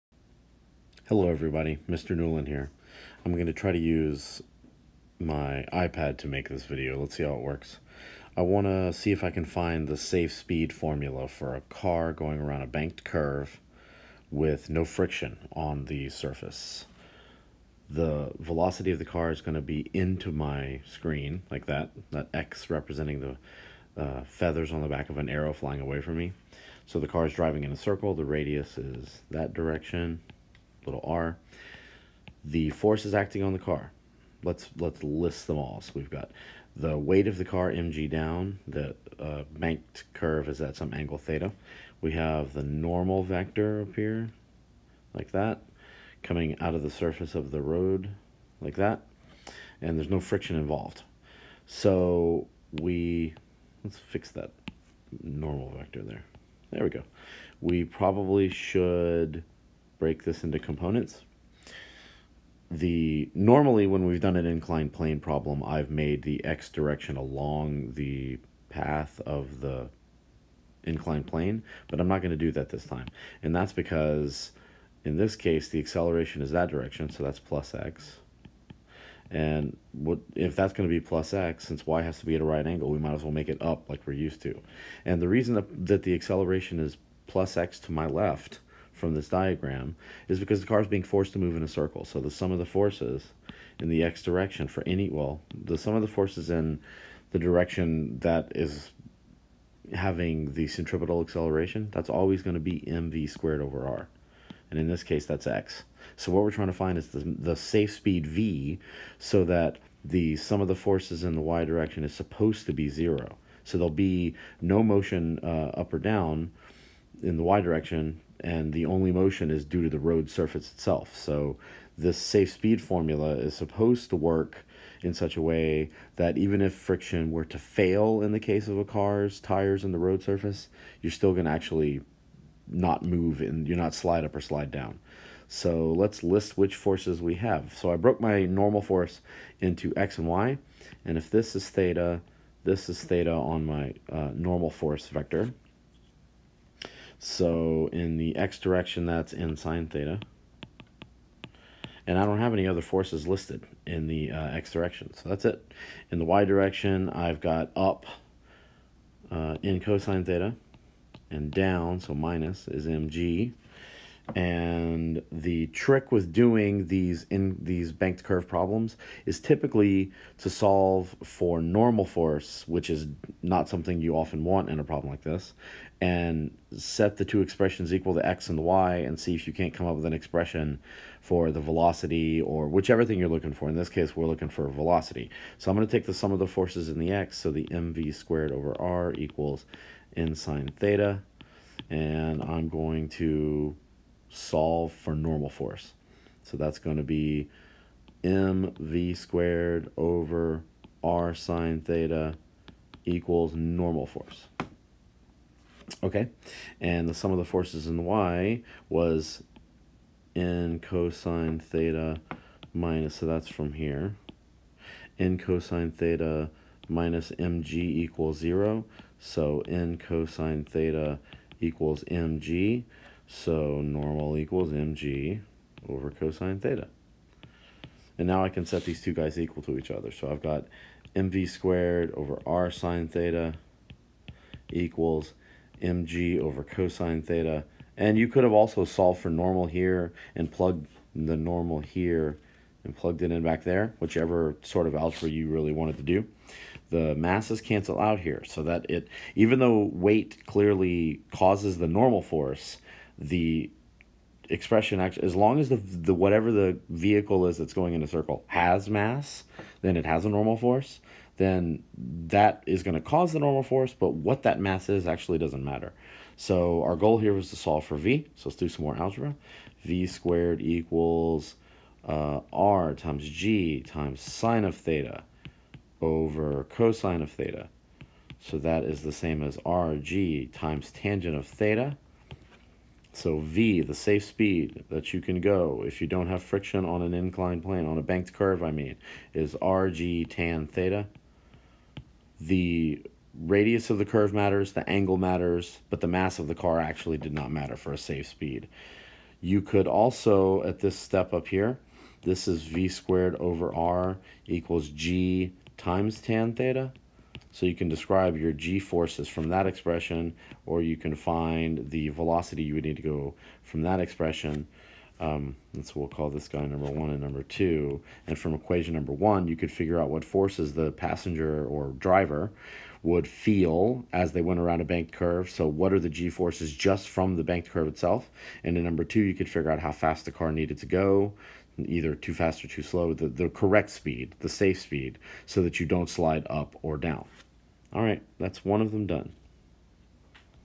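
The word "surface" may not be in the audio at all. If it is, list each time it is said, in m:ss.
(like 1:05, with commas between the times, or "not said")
0:16, 0:46, 2:00, 2:10.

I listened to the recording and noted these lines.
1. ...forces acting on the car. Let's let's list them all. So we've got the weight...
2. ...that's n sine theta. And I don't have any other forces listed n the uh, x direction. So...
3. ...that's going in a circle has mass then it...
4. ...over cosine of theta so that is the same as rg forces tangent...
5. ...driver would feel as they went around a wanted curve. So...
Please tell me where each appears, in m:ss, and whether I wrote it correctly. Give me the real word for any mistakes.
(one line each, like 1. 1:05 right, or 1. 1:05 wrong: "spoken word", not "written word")
1. 0:32 right
2. 2:29 right
3. 4:17 right
4. 4:36 wrong: "times", not "forces"
5. 5:21 wrong: "banked", not "wanted".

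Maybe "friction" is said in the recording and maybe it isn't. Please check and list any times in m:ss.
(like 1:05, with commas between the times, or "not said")
0:14, 0:50, 2:06, 4:46.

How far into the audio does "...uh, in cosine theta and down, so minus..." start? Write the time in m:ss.
2:39.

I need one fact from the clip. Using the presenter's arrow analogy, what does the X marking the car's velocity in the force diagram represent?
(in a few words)
feathers on the back of an arrow.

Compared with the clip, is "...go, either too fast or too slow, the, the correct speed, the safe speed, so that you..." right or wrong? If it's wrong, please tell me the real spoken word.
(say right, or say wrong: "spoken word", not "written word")
right.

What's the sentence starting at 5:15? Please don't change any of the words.
Um, and so we'll call this guy number one and number two.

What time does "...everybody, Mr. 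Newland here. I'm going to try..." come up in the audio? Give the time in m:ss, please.
0:01.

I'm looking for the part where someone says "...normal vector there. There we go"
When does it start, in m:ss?
0:55.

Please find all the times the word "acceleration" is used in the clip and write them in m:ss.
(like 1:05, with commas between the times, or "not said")
1:15, 1:26, 1:41.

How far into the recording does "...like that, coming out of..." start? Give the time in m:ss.
0:45.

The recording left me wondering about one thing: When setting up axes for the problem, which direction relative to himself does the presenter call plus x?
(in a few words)
to my left.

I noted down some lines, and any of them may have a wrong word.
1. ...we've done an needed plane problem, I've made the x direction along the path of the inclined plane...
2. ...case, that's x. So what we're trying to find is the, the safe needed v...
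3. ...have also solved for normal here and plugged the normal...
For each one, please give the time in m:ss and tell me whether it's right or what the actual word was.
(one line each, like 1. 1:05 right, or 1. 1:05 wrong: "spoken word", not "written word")
1. 1:04 wrong: "inclined", not "needed"
2. 1:45 wrong: "speed", not "needed"
3. 3:58 right.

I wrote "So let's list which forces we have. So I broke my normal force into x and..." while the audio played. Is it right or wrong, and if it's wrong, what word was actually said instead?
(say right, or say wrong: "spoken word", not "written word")
right.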